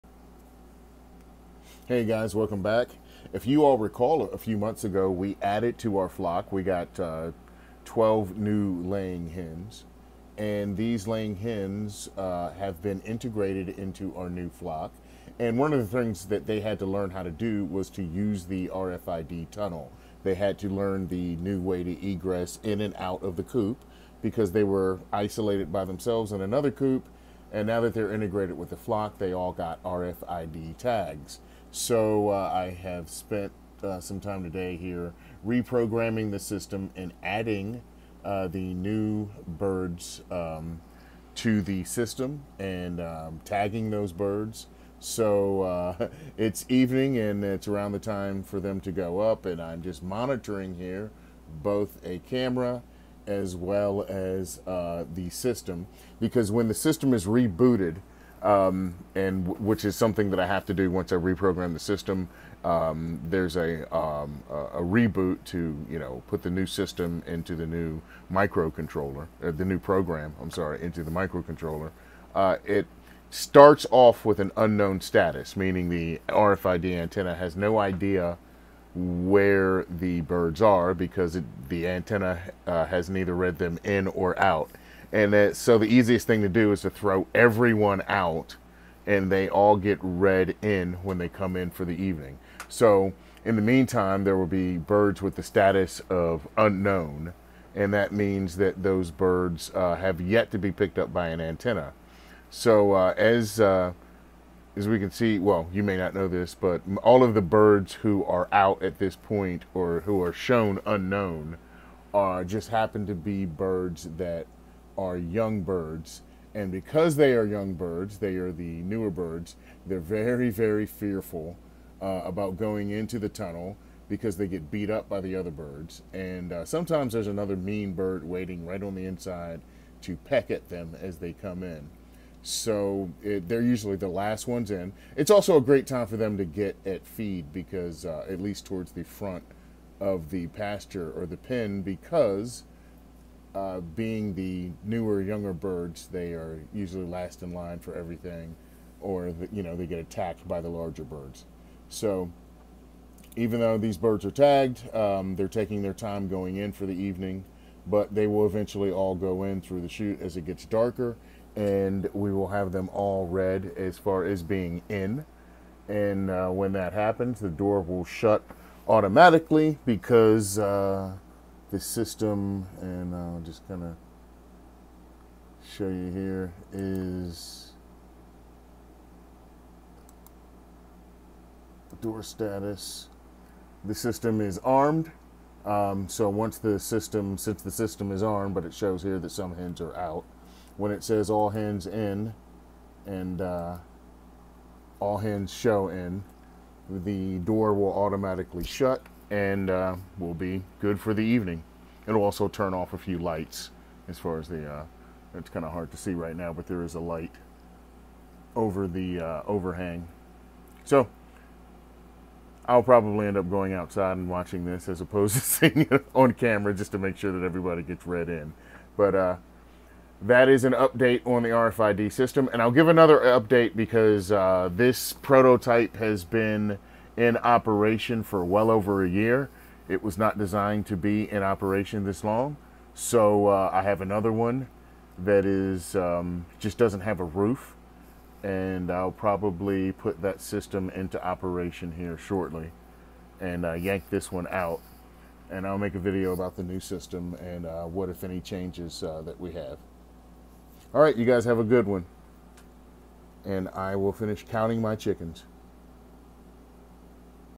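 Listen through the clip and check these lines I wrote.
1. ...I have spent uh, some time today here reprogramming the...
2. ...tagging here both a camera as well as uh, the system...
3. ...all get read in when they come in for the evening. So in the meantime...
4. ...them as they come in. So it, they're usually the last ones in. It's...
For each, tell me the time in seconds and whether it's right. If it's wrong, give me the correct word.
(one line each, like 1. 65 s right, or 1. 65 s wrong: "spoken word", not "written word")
1. 32 s right
2. 50 s wrong: "monitoring", not "tagging"
3. 89 s right
4. 130 s right.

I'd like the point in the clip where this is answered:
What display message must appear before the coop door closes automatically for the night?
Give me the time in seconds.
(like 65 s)
191 s.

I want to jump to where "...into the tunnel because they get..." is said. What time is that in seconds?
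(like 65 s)
122 s.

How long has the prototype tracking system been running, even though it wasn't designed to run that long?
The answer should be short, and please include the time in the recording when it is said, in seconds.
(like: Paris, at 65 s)
Over a year, at 228 s.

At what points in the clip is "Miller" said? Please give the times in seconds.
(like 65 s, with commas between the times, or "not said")
not said.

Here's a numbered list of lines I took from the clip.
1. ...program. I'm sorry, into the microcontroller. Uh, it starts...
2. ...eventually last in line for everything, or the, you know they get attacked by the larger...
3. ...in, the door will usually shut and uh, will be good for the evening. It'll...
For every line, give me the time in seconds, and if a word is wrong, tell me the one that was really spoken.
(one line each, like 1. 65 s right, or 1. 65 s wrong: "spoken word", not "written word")
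1. 69 s right
2. 146 s wrong: "usually", not "eventually"
3. 195 s wrong: "automatically", not "usually".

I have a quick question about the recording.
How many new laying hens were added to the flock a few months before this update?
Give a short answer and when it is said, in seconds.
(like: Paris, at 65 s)
12, at 7 s.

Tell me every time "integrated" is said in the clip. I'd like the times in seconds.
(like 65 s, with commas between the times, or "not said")
13 s, 28 s.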